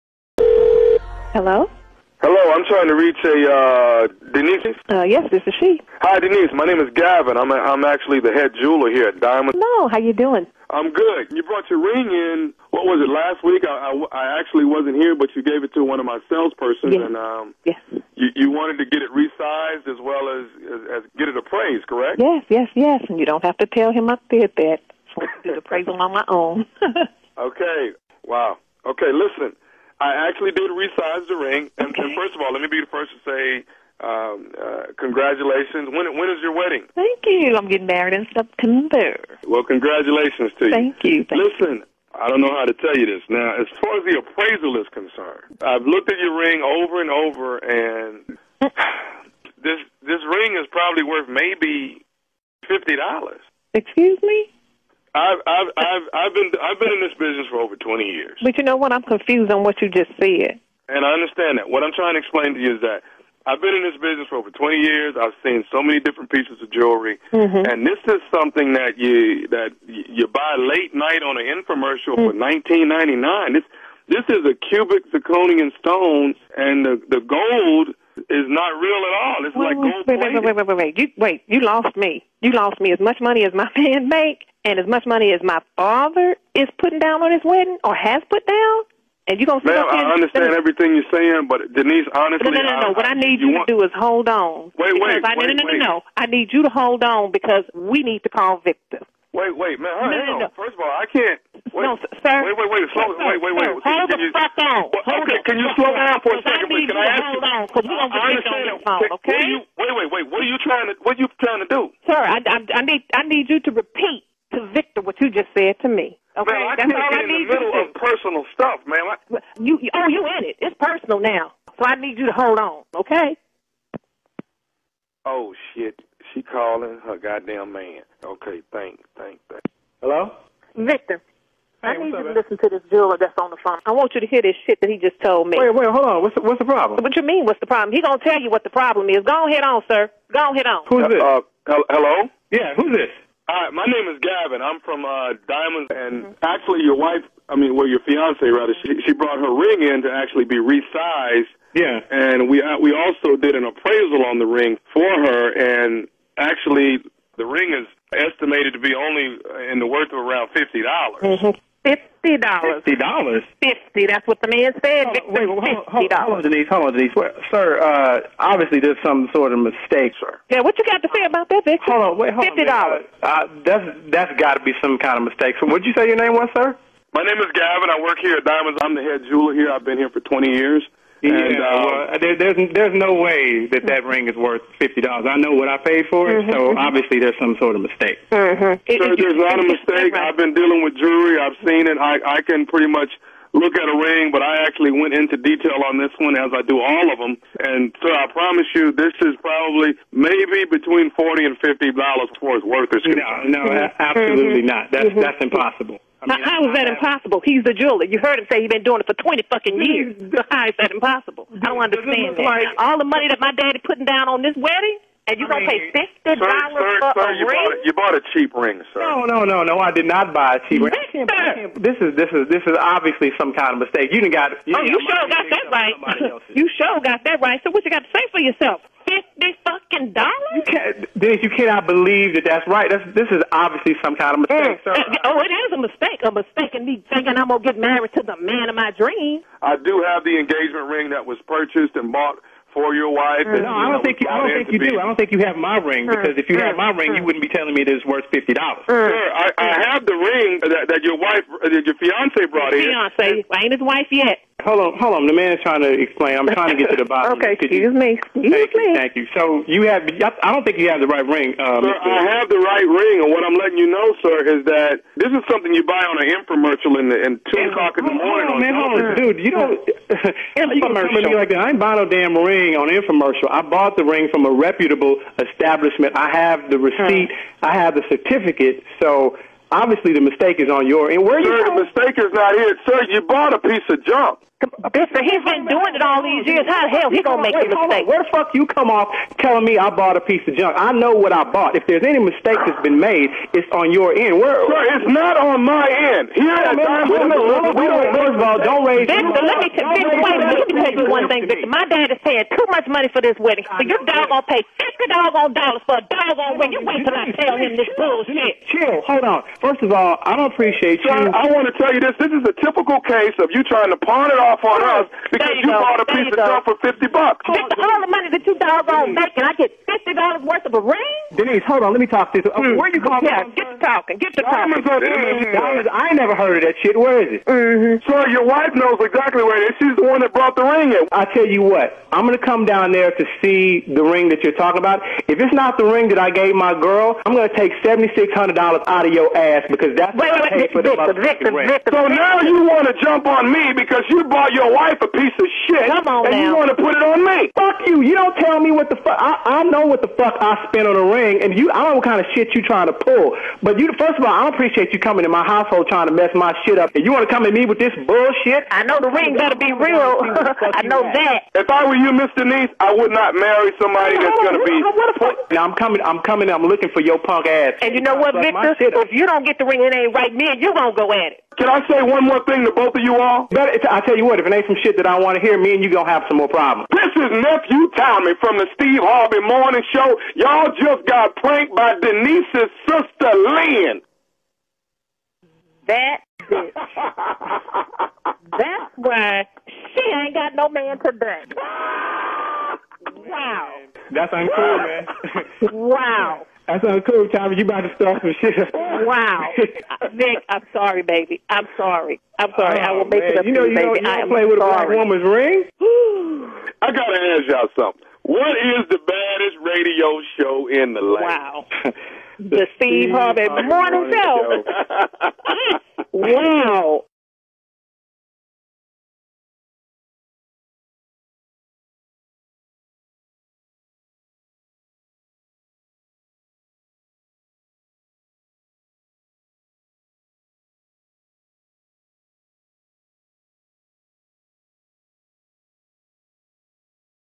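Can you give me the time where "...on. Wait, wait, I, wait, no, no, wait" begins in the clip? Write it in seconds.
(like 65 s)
94 s.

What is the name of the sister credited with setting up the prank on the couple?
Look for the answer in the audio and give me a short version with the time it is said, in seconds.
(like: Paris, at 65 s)
Lynn, at 383 s.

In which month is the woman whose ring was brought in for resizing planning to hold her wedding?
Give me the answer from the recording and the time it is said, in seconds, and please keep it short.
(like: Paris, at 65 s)
September, at 38 s.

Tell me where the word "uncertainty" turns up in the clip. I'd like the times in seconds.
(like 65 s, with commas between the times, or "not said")
not said.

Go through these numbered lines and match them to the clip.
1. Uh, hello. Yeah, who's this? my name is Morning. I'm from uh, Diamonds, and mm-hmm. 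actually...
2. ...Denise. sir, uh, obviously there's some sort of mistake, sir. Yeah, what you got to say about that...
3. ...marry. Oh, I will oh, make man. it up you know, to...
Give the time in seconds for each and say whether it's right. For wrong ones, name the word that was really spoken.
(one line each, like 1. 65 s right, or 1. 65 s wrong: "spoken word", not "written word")
1. 141 s wrong: "Gavin", not "Morning"
2. 166 s right
3. 402 s wrong: "sorry", not "marry".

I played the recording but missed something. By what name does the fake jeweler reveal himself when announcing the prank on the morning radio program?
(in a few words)
Nephew Tommy.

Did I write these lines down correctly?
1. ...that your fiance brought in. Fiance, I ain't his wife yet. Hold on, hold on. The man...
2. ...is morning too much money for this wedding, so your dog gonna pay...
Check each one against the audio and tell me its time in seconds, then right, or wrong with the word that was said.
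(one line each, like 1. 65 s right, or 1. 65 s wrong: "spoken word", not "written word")
1. 251 s right
2. 302 s wrong: "paying", not "morning".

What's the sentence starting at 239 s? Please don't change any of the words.
I do have the engagement ring that was purchased and bought for your wife.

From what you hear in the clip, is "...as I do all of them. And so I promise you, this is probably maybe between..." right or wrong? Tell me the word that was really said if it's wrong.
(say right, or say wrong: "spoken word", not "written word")
right.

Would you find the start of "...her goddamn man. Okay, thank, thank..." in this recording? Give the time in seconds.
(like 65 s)
127 s.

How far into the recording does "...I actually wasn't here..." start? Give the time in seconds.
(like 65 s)
14 s.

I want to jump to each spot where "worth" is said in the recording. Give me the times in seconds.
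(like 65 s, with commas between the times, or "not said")
51 s, 159 s, 184 s, 202 s, 248 s, 320 s.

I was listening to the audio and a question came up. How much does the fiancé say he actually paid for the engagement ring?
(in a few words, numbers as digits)
$7,600.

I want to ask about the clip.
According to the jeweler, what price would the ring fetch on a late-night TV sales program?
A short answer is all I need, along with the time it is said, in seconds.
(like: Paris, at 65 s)
19.99, at 72 s.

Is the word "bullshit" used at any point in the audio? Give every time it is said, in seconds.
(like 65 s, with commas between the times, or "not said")
307 s, 358 s.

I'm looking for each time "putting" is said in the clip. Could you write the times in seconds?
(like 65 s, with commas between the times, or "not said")
86 s, 213 s.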